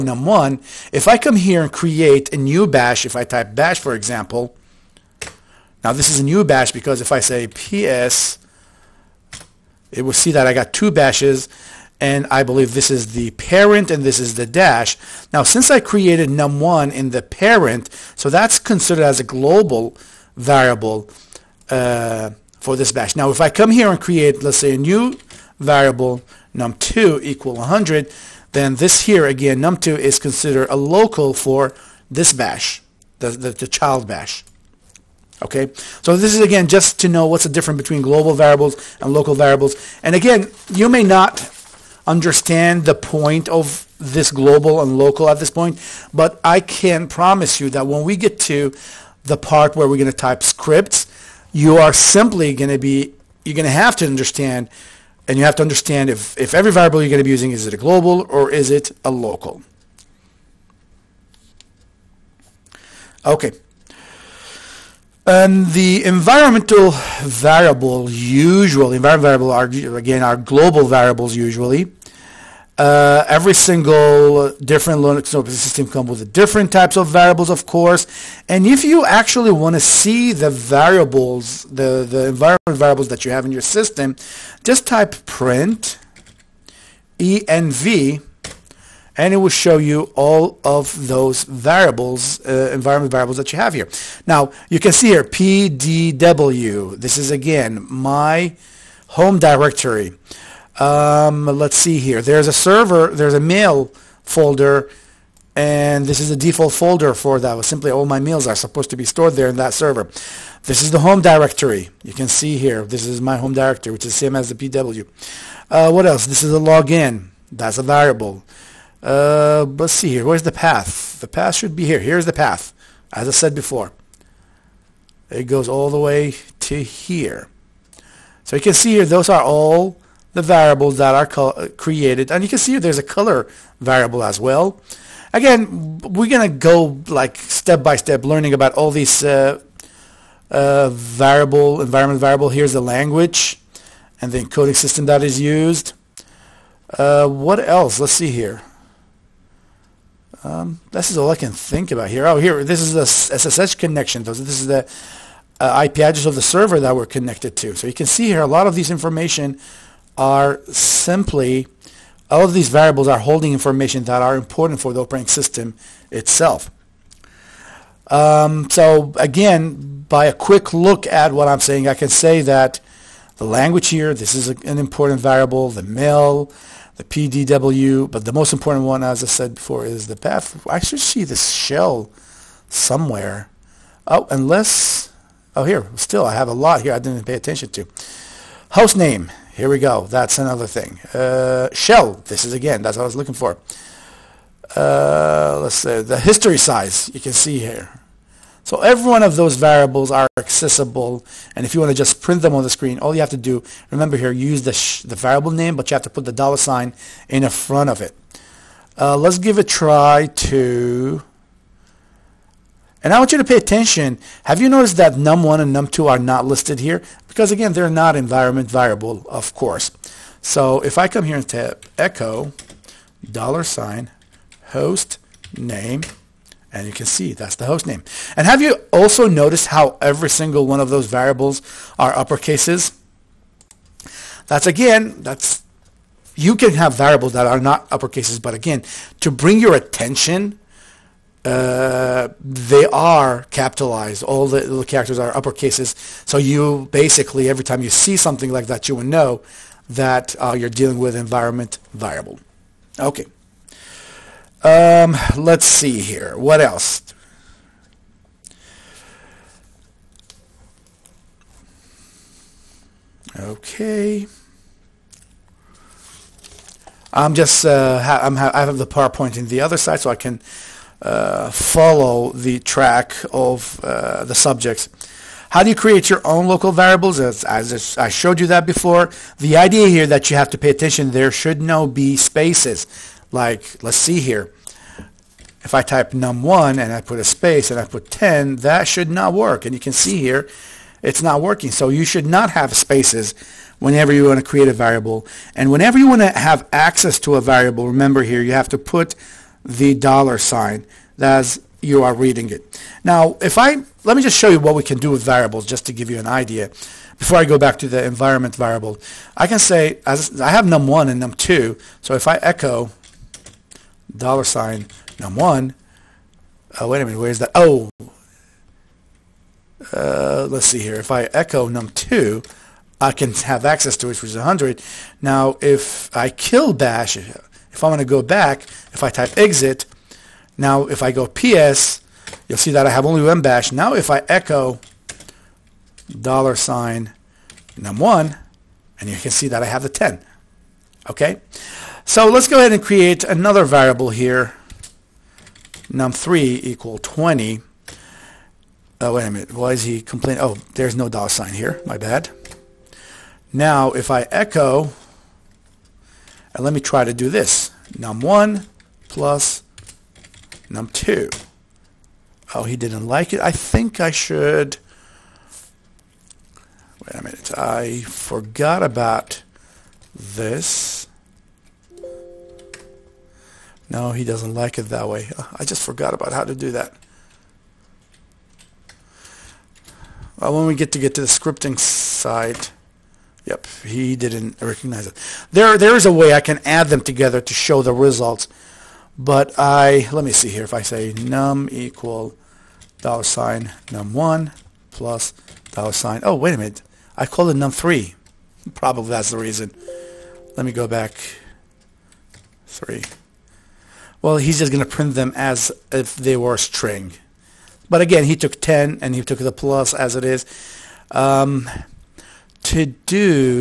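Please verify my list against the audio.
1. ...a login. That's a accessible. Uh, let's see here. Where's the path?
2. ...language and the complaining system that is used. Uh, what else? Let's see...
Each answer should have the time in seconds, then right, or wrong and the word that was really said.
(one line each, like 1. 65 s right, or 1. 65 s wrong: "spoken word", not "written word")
1. 116 s wrong: "variable", not "accessible"
2. 142 s wrong: "encoding", not "complaining".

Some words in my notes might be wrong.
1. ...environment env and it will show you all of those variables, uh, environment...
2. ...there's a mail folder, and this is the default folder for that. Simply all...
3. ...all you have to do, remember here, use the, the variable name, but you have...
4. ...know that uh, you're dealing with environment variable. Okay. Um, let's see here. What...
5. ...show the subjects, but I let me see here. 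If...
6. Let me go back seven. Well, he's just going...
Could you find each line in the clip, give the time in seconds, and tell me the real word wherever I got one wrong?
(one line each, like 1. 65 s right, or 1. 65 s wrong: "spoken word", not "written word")
1. 85 s wrong: "print", not "environment"
2. 103 s right
3. 202 s right
4. 249 s right
5. 387 s wrong: "results", not "subjects"
6. 400 s wrong: "three", not "seven".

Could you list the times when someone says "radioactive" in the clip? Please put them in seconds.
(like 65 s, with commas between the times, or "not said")
not said.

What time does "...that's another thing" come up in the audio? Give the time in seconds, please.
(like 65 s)
190 s.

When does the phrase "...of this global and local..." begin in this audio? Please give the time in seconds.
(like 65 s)
43 s.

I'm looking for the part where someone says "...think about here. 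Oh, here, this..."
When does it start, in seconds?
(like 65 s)
151 s.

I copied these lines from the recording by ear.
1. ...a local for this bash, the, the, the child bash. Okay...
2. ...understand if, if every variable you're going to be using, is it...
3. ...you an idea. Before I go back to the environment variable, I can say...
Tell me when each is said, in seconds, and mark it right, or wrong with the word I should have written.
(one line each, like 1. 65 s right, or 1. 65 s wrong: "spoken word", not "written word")
1. 30 s right
2. 55 s right
3. 306 s right.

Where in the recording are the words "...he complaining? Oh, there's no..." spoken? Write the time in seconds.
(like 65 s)
349 s.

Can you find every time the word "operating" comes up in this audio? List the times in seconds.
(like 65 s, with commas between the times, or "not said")
75 s, 165 s.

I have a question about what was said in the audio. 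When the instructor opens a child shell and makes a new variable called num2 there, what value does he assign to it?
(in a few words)
100.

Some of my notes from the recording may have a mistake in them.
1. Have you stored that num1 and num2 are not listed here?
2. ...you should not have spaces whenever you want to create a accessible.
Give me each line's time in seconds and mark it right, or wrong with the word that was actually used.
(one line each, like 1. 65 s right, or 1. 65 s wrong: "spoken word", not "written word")
1. 214 s wrong: "noticed", not "stored"
2. 291 s wrong: "variable", not "accessible".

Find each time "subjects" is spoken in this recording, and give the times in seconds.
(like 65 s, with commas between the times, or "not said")
274 s.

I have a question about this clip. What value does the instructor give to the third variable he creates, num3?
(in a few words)
20.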